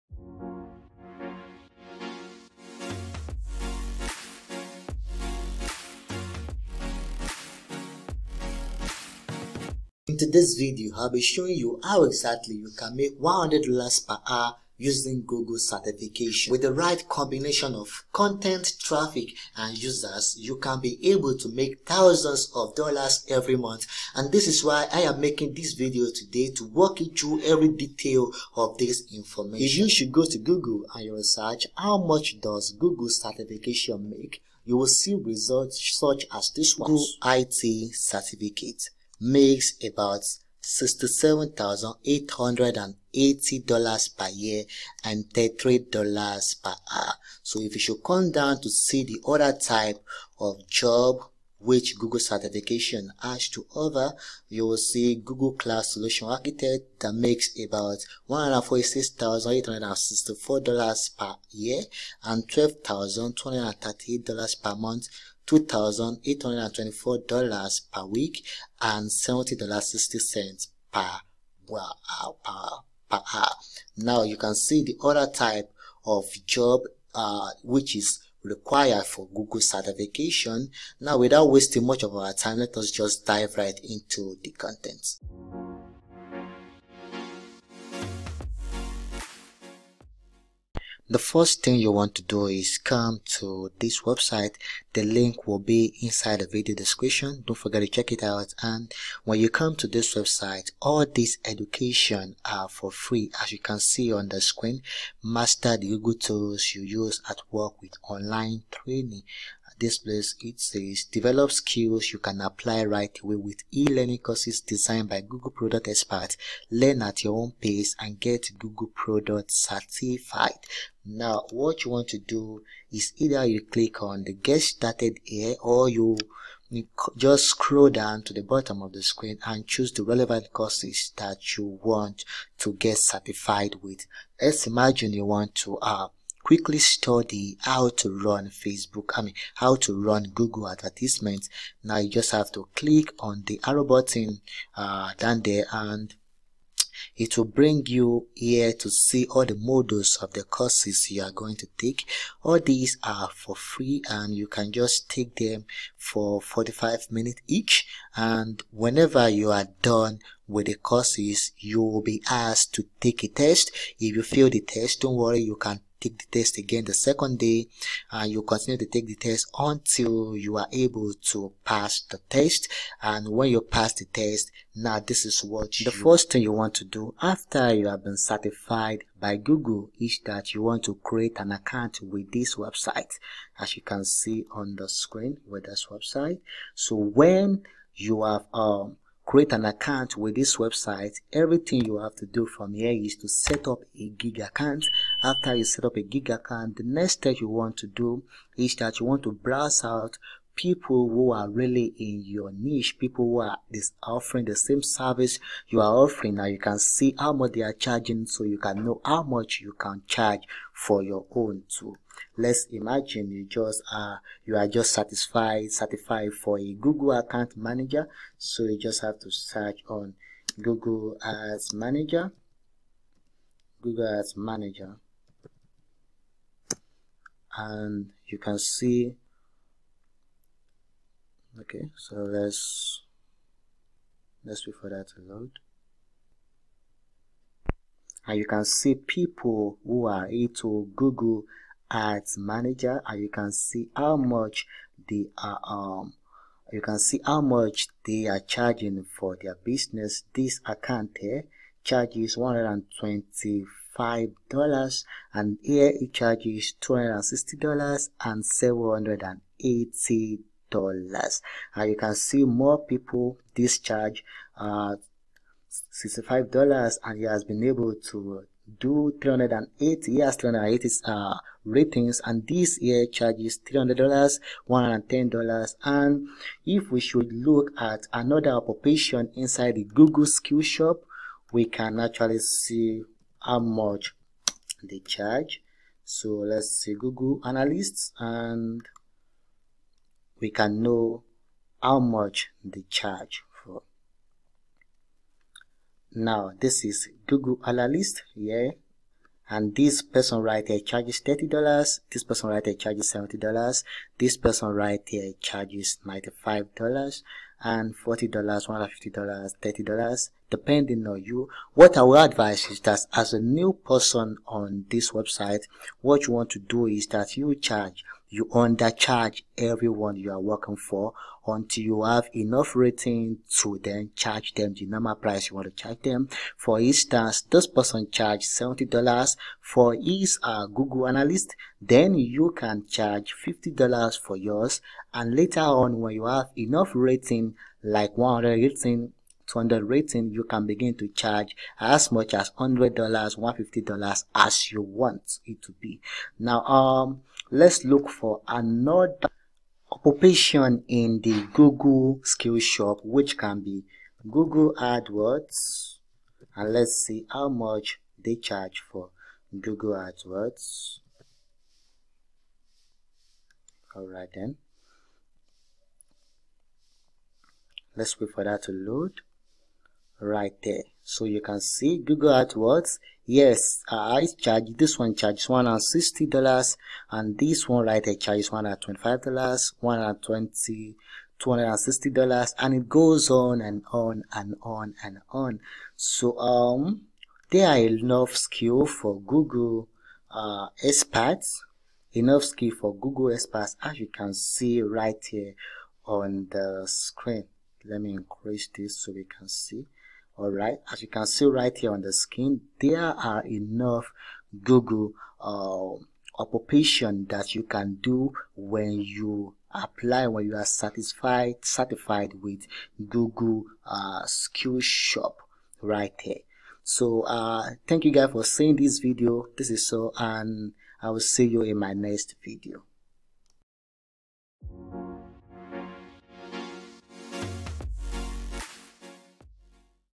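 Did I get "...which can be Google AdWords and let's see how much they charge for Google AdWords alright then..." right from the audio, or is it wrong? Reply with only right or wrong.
right.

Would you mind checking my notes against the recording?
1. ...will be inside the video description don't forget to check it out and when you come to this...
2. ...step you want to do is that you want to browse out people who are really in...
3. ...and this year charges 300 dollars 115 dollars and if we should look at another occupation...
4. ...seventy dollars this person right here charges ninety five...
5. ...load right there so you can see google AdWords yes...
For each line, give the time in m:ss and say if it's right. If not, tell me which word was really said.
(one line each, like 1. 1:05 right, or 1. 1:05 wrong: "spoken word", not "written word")
1. 1:35 right
2. 3:17 right
3. 4:32 wrong: "110", not "115"
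4. 5:03 right
5. 6:08 right.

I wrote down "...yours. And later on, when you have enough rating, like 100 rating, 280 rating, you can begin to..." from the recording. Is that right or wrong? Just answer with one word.
wrong.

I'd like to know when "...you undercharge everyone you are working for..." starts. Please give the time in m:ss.
5:18.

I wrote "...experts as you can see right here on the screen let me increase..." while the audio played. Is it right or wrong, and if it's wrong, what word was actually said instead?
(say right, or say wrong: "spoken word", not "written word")
right.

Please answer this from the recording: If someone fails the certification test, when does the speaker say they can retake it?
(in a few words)
the second day.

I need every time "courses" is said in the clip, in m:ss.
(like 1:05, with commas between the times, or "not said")
1:54, 2:10, 2:30, 2:40.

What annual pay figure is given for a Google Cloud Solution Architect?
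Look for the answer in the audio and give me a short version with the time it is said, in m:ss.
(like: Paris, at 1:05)
$146,864, at 0:58.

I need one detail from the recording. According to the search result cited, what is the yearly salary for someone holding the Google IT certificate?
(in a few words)
$67,880.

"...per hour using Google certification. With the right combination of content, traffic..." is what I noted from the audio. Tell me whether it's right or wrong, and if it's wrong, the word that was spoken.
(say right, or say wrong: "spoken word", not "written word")
right.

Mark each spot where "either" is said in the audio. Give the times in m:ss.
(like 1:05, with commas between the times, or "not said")
2:03.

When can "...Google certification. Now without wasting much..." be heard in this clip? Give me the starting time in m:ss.
1:19.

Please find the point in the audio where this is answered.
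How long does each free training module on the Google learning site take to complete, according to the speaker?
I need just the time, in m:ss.
2:36.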